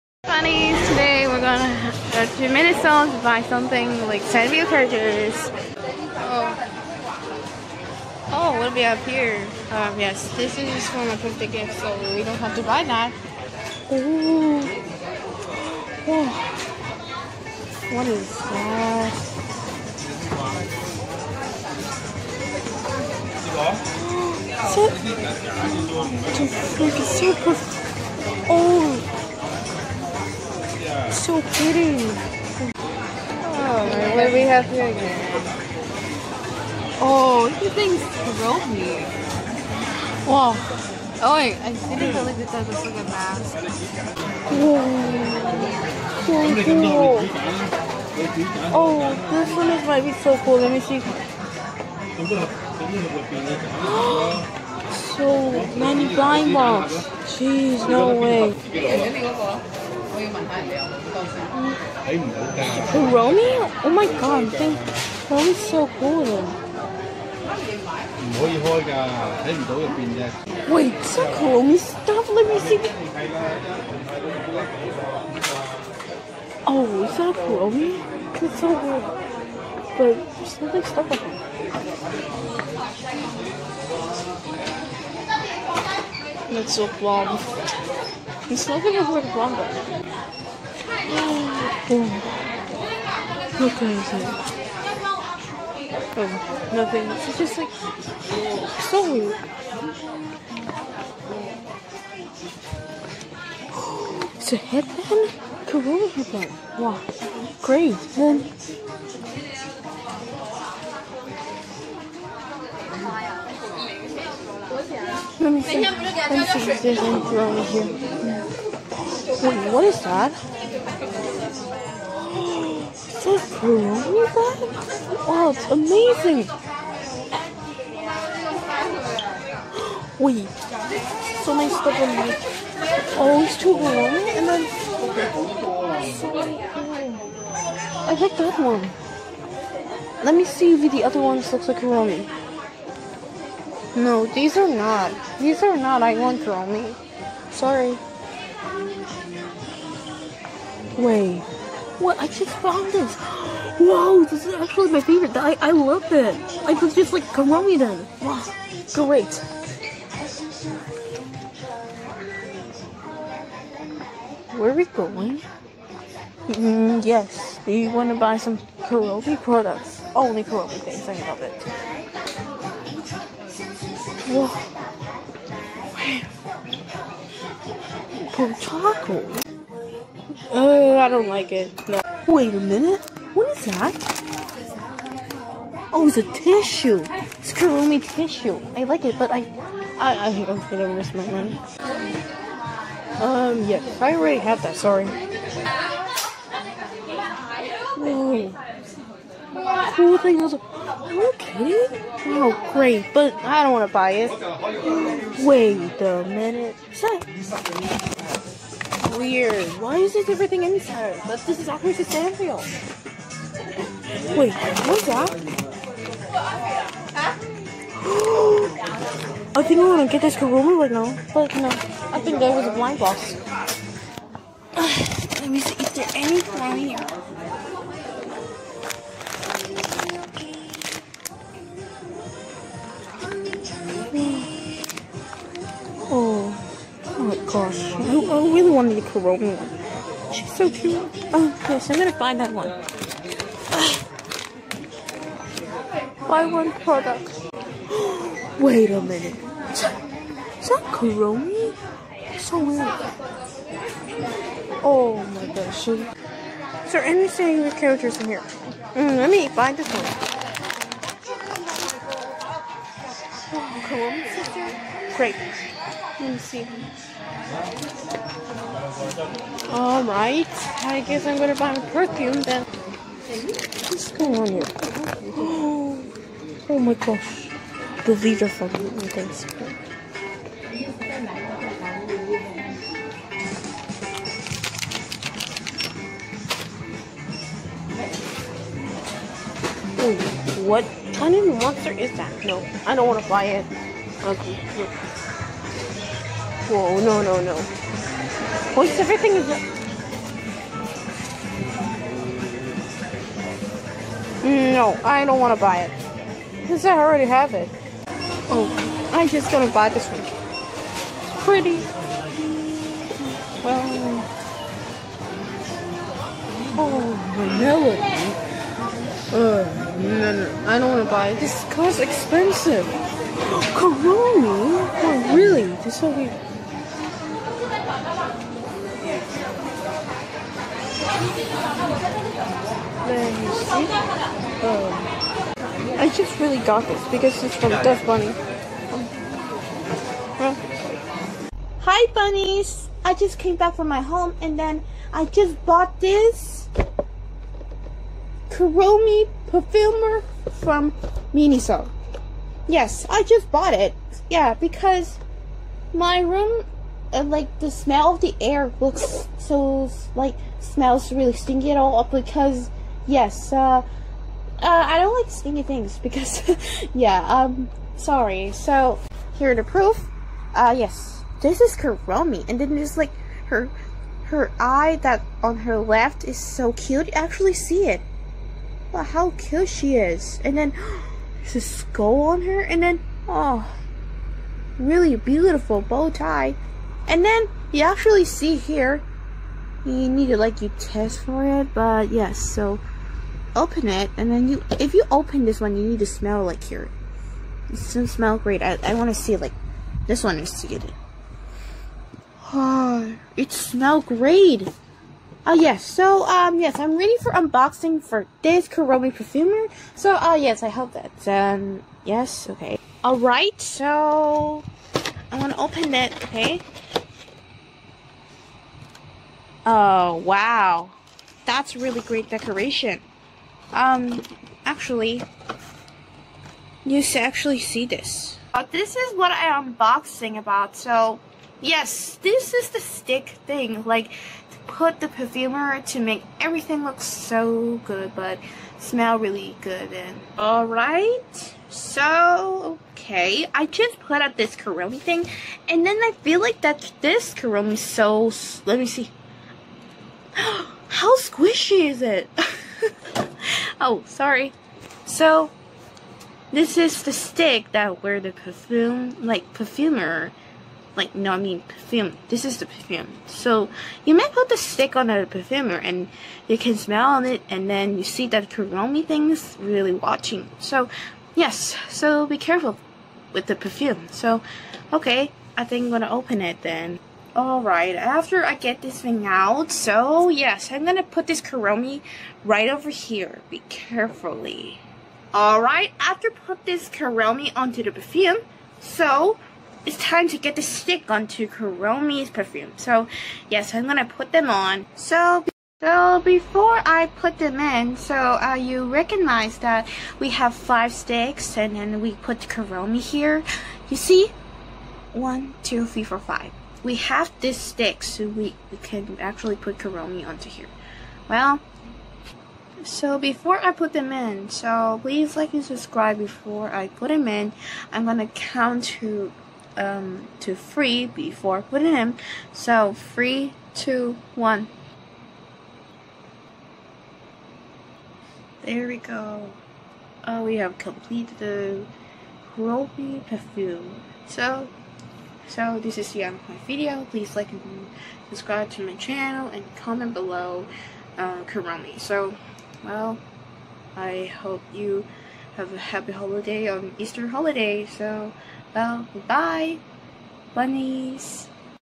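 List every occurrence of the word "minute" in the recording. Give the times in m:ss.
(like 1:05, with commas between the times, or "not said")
0:02, 3:02, 3:26, 4:09.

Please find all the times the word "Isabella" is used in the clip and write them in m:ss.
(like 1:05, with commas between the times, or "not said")
not said.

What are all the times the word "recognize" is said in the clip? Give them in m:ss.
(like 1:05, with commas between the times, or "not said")
8:18.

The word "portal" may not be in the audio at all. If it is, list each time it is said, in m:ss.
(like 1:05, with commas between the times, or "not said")
not said.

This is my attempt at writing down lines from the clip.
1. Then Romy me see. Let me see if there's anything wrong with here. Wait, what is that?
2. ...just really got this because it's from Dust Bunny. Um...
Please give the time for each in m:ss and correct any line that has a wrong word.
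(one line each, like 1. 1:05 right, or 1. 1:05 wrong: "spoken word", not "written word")
1. 1:48 wrong: "Let", not "Romy"
2. 5:36 right.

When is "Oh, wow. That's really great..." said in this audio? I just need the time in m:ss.
6:59.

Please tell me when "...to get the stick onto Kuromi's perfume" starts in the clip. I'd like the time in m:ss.
8:10.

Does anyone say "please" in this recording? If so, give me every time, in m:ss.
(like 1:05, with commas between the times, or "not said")
8:35, 8:57.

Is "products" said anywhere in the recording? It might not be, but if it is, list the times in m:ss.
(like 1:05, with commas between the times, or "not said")
2:49, 4:06.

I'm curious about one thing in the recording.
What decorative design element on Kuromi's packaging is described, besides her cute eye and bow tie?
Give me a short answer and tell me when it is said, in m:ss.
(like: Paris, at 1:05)
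A skull, at 6:21.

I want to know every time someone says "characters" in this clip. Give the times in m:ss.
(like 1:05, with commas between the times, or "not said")
0:04, 4:17.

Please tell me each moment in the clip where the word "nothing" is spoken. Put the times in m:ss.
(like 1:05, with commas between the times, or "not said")
1:20, 1:28, 1:36.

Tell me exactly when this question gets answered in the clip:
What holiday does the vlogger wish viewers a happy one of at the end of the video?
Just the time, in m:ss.
9:06.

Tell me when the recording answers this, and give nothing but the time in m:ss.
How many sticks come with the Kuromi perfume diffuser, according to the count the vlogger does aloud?
8:20.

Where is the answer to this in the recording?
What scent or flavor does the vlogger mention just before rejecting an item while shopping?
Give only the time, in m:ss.
5:19.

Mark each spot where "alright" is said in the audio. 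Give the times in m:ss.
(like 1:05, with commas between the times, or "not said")
4:29, 6:53, 7:20, 7:57, 8:05.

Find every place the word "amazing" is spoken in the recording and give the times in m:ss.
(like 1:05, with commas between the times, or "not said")
2:05.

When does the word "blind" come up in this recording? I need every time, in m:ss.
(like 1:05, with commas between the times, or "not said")
0:56, 3:42.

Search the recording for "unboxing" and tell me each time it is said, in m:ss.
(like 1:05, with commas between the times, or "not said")
6:47, 7:09.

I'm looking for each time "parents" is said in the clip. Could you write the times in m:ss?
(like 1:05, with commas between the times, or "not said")
not said.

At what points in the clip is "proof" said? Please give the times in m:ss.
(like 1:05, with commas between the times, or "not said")
6:09.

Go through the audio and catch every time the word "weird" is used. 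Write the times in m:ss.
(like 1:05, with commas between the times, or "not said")
3:29, 4:12, 5:26.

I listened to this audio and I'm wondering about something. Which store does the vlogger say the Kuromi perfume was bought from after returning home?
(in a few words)
Miniso.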